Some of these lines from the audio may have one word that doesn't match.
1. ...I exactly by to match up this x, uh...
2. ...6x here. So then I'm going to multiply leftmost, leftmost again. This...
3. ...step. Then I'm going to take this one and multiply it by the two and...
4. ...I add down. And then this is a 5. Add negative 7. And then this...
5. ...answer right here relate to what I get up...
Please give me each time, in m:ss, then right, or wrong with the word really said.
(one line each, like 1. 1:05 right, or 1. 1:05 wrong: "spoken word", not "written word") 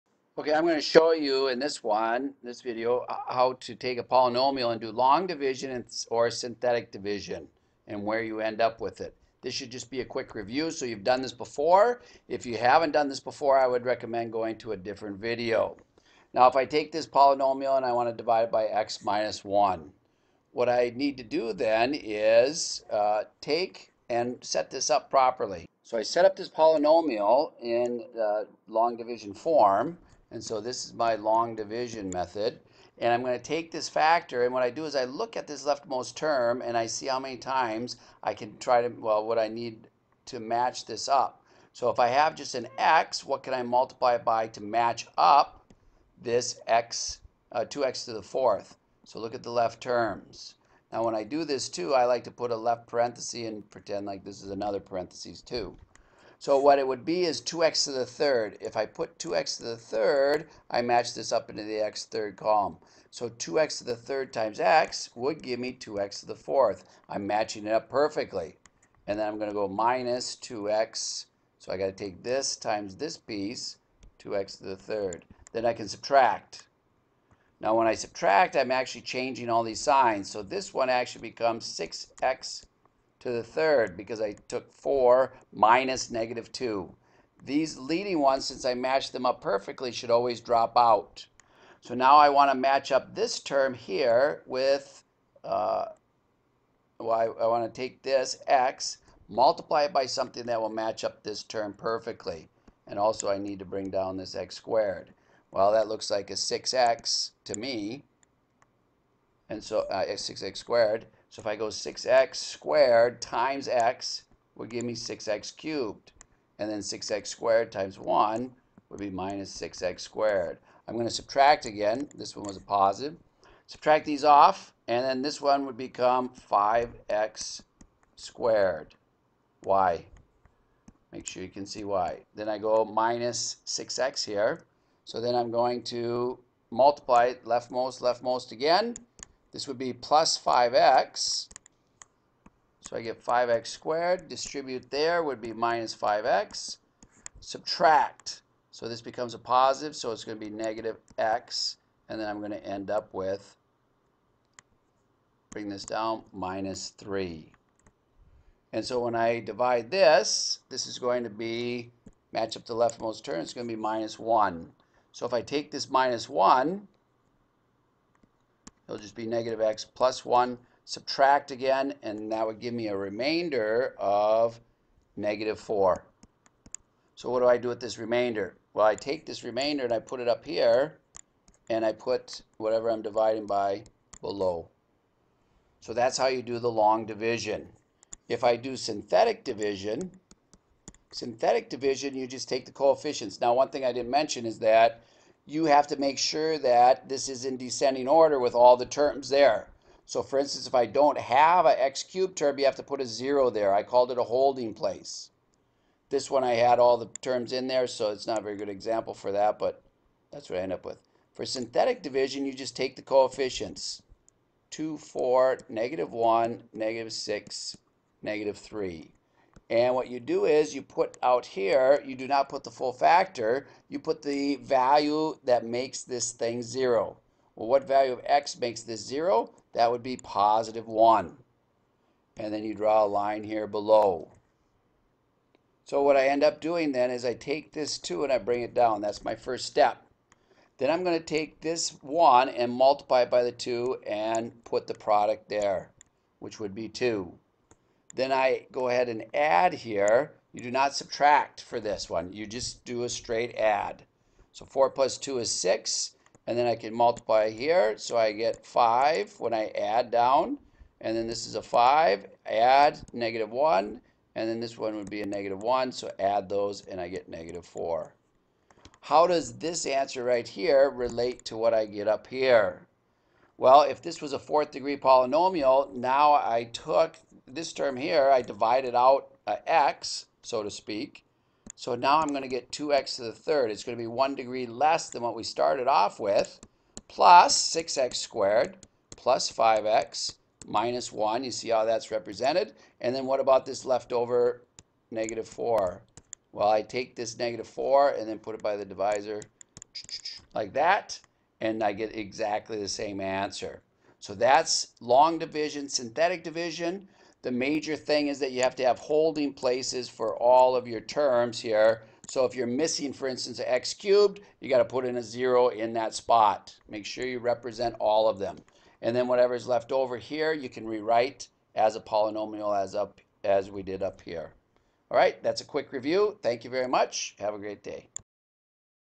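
1. 0:43 wrong: "multiply", not "exactly"
2. 2:13 right
3. 3:59 right
4. 4:19 wrong: "1", not "7"
5. 4:29 right.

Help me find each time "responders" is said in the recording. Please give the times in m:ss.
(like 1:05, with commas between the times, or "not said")
not said.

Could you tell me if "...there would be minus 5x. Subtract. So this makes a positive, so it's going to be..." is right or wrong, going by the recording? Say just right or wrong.
wrong.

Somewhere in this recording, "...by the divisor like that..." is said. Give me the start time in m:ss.
4:58.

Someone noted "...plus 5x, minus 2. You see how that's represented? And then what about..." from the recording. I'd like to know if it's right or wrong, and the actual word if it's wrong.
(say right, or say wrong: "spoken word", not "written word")
wrong: "1", not "2".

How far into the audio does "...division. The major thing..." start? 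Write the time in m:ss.
5:06.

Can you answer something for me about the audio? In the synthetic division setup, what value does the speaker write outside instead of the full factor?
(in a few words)
1.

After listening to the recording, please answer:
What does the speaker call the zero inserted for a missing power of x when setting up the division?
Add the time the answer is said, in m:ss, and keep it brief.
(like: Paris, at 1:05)
holding place, at 3:24.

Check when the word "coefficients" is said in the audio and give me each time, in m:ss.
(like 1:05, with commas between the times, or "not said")
3:12, 3:33.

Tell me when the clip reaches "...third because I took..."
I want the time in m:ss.
1:23.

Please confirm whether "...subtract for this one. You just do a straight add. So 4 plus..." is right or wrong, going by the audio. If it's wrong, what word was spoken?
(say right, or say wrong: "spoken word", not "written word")
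right.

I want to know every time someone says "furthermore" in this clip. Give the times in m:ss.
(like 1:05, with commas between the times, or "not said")
not said.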